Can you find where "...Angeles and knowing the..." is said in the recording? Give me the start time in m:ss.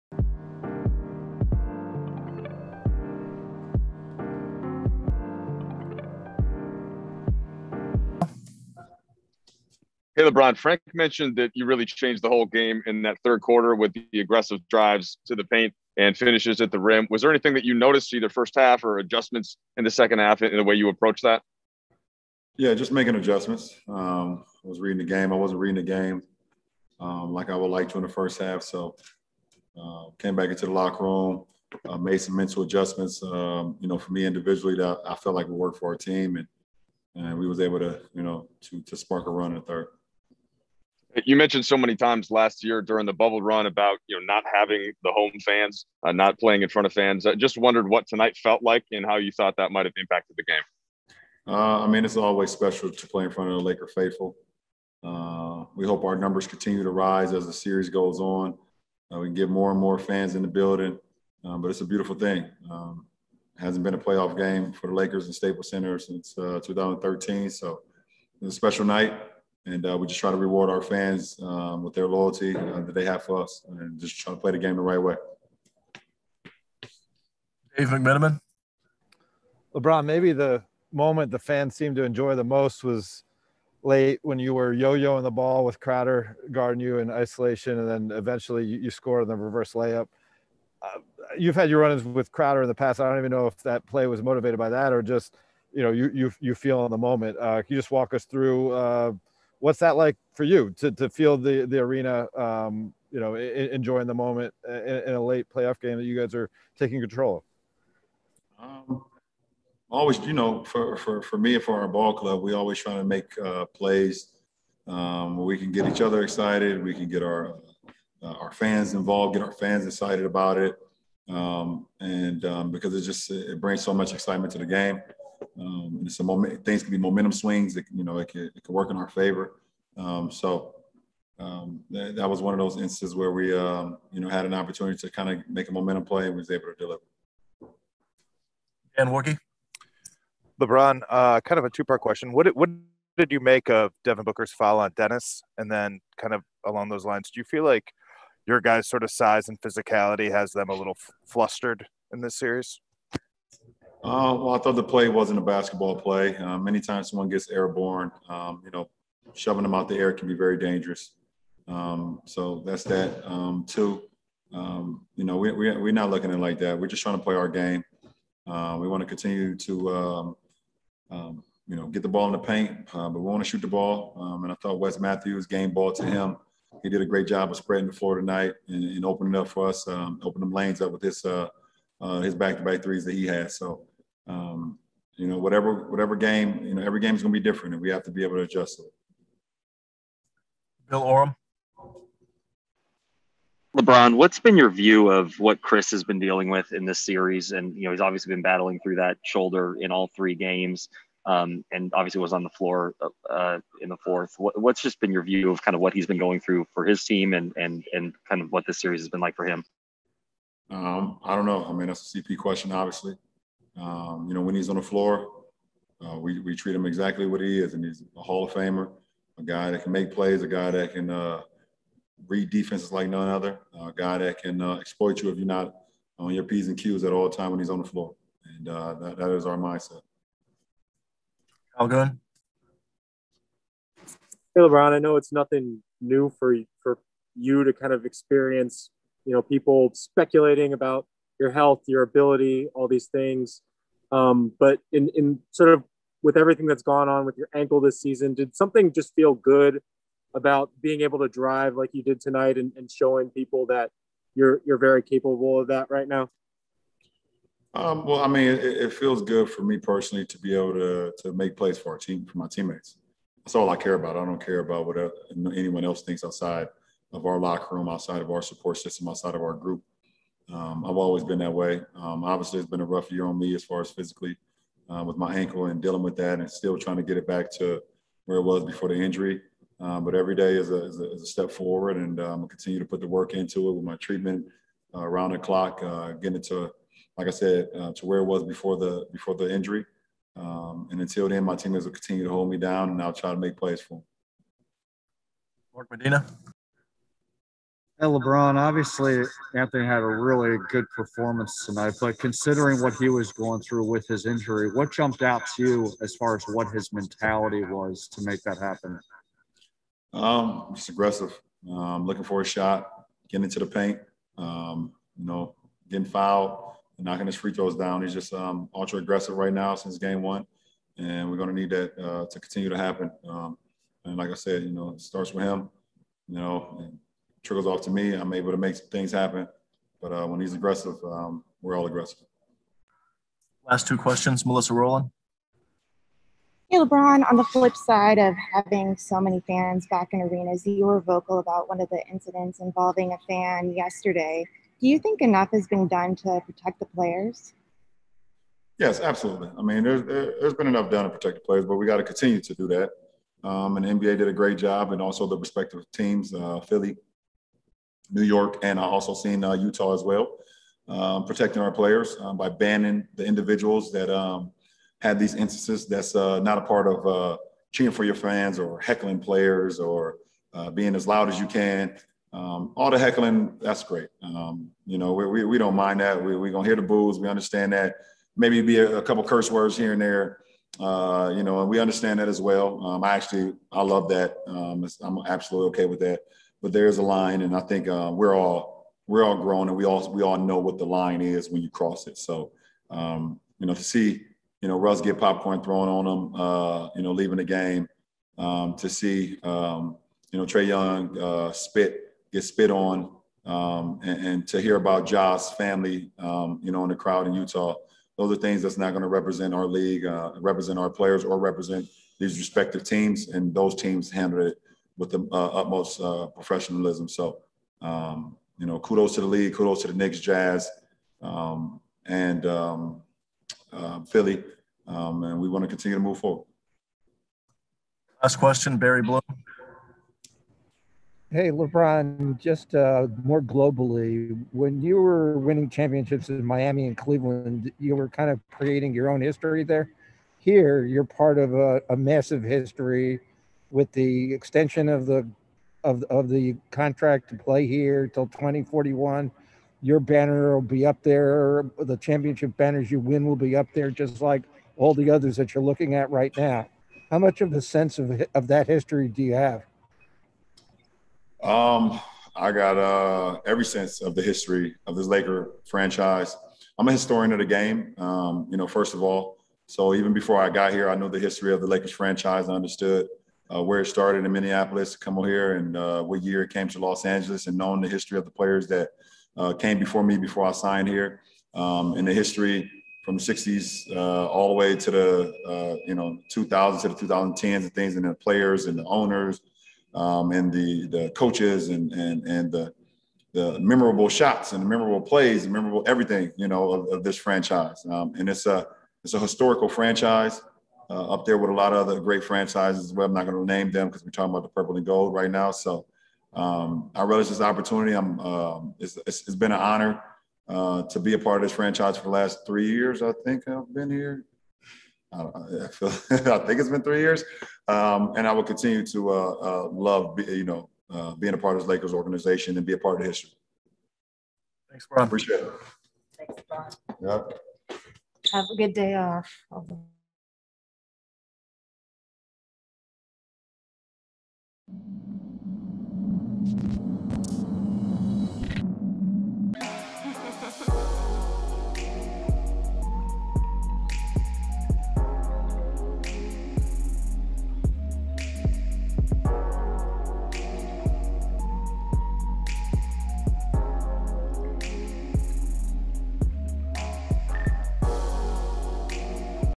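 7:57.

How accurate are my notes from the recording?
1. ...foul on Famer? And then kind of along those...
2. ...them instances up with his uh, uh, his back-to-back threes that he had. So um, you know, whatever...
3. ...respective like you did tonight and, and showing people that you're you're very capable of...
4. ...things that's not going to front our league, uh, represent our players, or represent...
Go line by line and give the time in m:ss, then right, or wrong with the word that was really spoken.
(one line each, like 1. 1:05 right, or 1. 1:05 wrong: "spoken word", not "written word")
1. 2:24 wrong: "Dennis", not "Famer"
2. 3:00 wrong: "lanes", not "instances"
3. 4:11 wrong: "drive", not "respective"
4. 6:48 wrong: "represent", not "front".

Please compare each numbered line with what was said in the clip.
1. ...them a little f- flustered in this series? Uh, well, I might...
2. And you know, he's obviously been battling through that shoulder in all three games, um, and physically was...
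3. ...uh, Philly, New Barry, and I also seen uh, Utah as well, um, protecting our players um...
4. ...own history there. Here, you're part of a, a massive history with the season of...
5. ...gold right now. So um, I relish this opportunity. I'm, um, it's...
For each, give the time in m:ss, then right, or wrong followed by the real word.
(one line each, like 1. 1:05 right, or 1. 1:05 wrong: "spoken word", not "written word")
1. 2:30 wrong: "thought", not "might"
2. 3:17 wrong: "obviously", not "physically"
3. 5:56 wrong: "York", not "Barry"
4. 7:19 wrong: "extension", not "season"
5. 8:24 right.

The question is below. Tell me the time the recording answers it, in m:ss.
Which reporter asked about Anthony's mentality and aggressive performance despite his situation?
4:55.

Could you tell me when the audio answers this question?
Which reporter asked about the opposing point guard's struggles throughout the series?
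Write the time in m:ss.
3:10.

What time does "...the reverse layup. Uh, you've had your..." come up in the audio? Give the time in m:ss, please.
1:29.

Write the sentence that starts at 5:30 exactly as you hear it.
But uh, when he's aggressive, um, we're all aggressive.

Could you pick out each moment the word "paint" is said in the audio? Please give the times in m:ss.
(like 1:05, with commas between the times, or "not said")
0:15, 2:52, 5:13.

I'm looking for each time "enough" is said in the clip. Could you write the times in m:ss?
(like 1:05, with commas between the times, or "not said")
5:45, 5:50.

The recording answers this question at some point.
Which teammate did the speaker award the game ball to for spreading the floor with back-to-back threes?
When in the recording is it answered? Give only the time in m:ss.
2:54.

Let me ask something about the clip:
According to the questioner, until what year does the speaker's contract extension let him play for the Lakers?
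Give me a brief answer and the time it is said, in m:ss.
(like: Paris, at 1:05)
2041, at 7:28.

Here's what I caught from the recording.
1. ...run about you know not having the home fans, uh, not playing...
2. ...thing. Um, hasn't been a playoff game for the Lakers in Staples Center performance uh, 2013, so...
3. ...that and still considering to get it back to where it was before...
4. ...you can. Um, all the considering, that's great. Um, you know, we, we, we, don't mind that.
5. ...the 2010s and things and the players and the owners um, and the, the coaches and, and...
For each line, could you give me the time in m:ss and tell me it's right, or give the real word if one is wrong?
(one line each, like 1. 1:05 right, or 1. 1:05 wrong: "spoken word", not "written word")
1. 0:43 right
2. 1:02 wrong: "since", not "performance"
3. 4:36 wrong: "trying", not "considering"
4. 6:11 wrong: "heckling", not "considering"
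5. 8:06 right.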